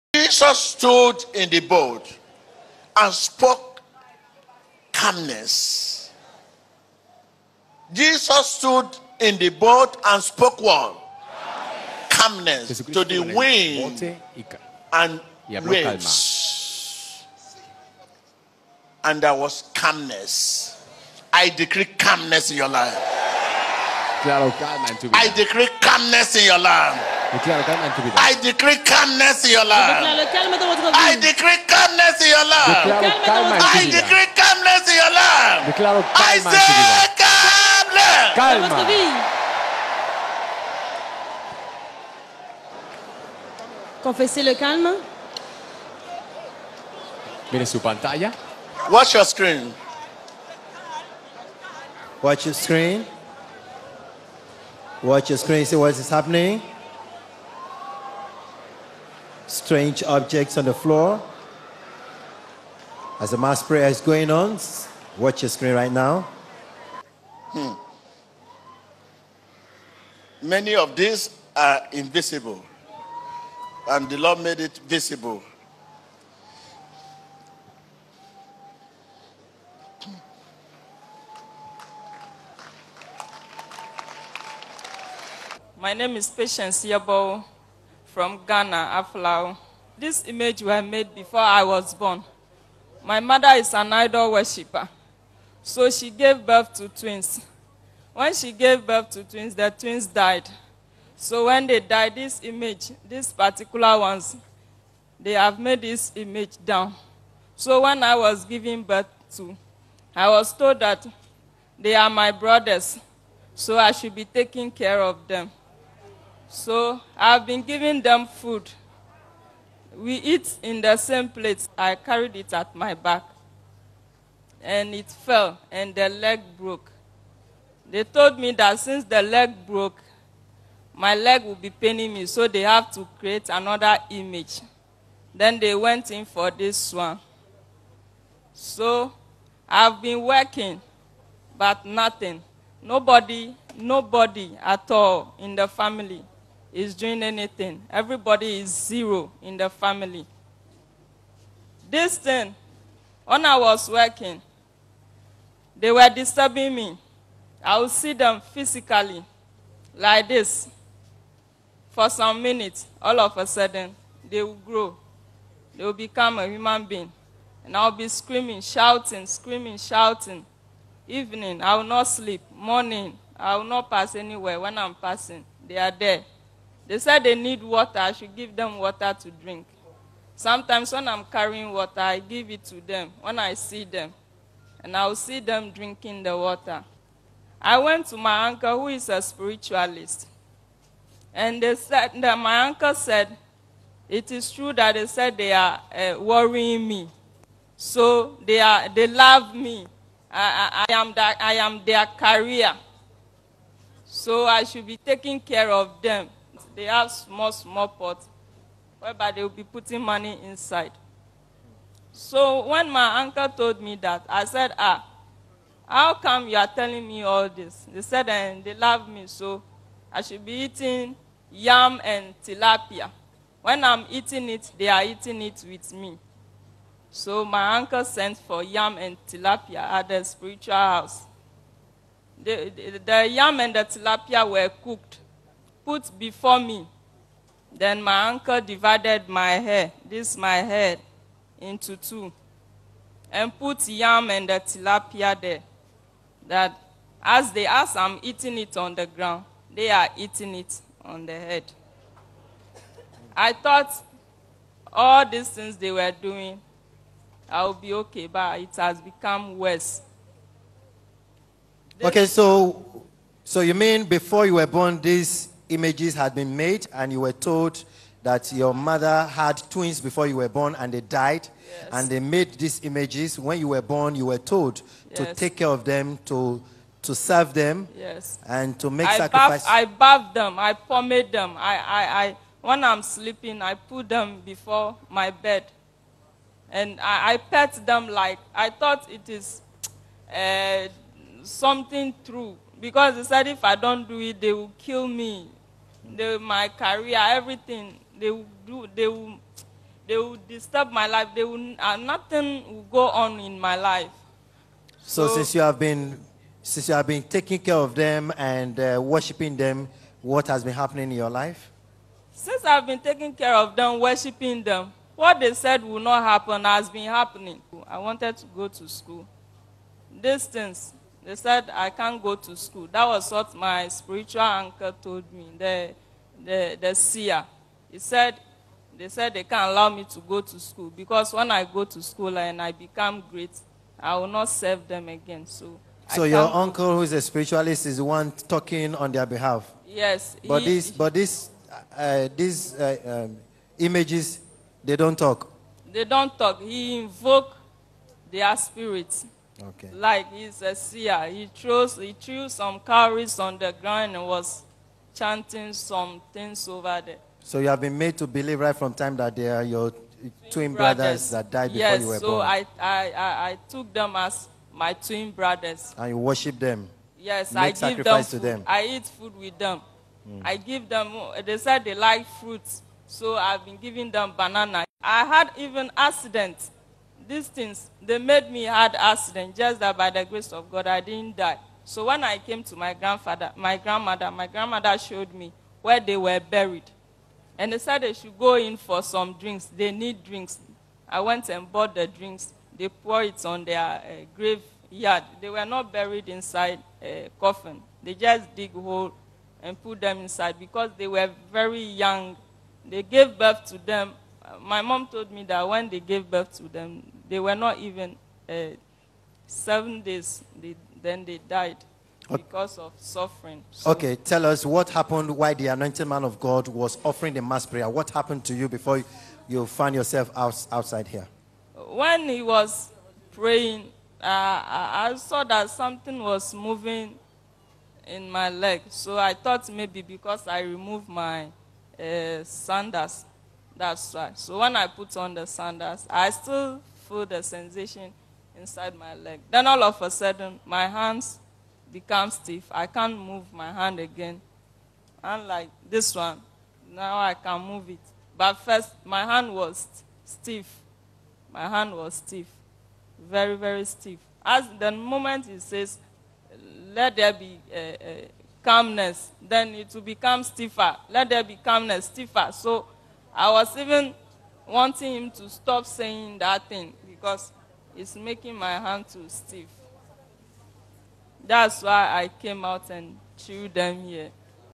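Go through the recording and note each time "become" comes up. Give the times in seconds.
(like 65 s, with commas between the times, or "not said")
165 s, 258 s, 332 s, 441 s, 460 s.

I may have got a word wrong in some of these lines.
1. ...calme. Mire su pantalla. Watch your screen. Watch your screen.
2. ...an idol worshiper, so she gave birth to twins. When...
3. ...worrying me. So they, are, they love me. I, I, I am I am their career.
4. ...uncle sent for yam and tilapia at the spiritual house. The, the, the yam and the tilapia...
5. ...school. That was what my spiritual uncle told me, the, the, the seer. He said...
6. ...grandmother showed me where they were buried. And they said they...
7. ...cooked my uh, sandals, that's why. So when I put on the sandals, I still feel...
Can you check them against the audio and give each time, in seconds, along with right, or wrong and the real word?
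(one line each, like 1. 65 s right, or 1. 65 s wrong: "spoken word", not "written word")
1. 44 s right
2. 93 s right
3. 196 s right
4. 227 s right
5. 322 s right
6. 384 s right
7. 430 s wrong: "removed", not "cooked".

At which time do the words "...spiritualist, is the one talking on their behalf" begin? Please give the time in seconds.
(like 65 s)
337 s.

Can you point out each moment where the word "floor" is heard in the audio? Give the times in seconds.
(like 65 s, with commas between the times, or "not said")
60 s.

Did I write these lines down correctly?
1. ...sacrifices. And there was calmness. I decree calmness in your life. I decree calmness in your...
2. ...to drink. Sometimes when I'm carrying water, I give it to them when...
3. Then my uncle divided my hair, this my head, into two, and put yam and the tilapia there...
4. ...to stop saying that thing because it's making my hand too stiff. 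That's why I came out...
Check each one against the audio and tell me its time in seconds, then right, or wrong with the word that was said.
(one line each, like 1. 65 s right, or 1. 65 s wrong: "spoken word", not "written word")
1. 15 s wrong: "waves", not "sacrifices"
2. 179 s right
3. 237 s right
4. 465 s right.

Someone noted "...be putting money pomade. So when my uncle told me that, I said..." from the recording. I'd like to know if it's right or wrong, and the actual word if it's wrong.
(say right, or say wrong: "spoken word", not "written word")
wrong: "inside", not "pomade".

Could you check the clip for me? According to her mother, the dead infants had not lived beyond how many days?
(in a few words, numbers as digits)
7.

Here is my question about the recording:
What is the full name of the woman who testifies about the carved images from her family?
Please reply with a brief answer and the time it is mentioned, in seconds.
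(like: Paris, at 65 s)
Patience Yabo, at 86 s.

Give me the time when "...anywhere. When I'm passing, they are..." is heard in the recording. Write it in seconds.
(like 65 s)
174 s.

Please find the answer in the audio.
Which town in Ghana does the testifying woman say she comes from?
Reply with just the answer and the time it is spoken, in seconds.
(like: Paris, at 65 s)
Aflao, at 89 s.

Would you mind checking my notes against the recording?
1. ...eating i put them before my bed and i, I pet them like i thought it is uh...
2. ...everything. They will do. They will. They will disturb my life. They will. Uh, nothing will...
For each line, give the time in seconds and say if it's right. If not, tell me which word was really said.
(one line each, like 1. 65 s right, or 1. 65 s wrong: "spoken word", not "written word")
1. 283 s wrong: "sleeping", not "eating"
2. 297 s right.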